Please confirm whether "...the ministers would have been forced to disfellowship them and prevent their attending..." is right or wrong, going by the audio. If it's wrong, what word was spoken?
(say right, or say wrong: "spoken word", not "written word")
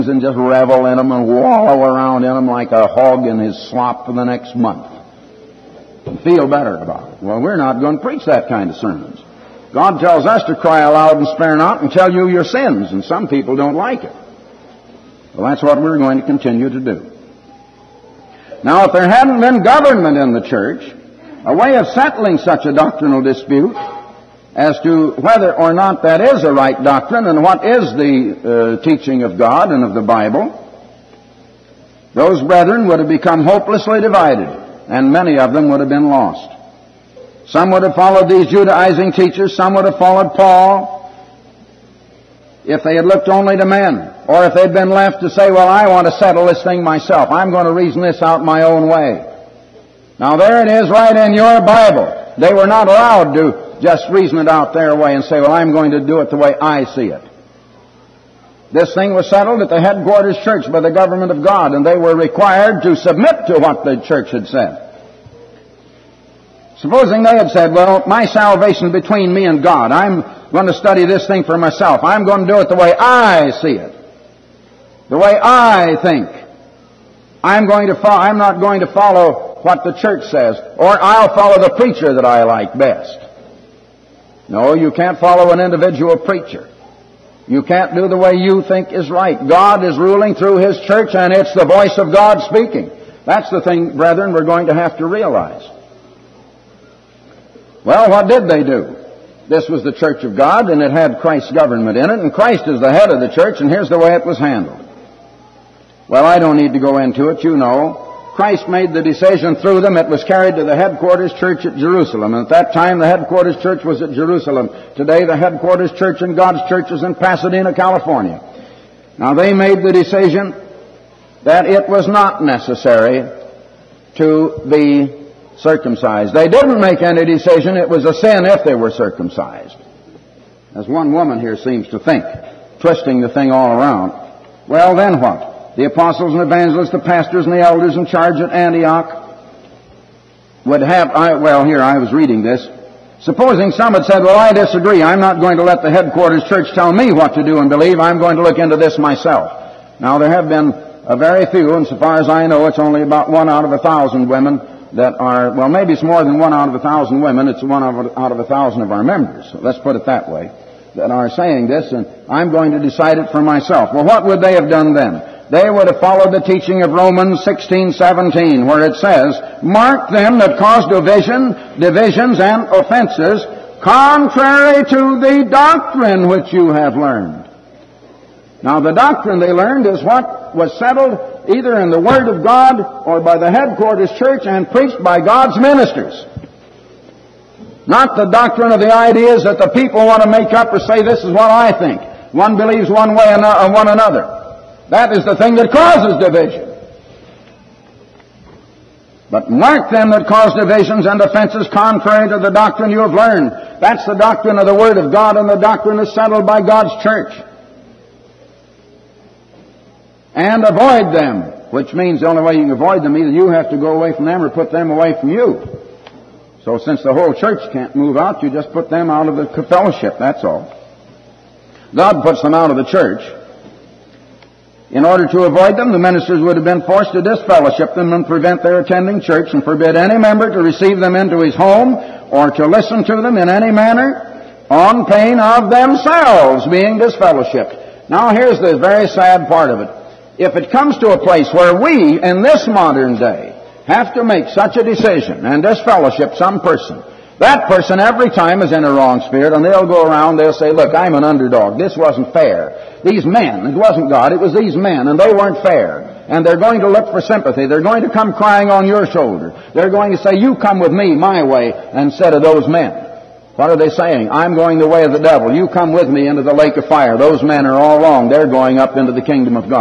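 right.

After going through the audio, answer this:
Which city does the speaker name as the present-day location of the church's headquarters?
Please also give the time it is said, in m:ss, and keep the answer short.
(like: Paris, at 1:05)
Pasadena, California, at 1:57.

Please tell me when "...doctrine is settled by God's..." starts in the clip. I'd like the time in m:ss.
3:25.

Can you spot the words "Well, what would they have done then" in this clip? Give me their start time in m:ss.
2:43.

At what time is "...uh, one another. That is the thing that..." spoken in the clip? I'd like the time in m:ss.
3:13.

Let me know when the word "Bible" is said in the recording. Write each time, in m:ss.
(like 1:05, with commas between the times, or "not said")
0:30, 0:51.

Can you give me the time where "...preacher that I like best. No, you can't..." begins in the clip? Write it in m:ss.
1:21.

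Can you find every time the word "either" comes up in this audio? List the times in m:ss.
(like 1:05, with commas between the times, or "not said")
3:01, 3:33.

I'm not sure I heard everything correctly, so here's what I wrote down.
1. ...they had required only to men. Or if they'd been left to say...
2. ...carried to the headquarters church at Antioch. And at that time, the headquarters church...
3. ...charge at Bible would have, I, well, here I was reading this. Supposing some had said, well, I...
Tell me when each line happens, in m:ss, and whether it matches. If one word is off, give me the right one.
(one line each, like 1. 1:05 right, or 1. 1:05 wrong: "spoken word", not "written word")
1. 0:42 wrong: "looked", not "required"
2. 1:50 wrong: "Jerusalem", not "Antioch"
3. 2:18 wrong: "Antioch", not "Bible".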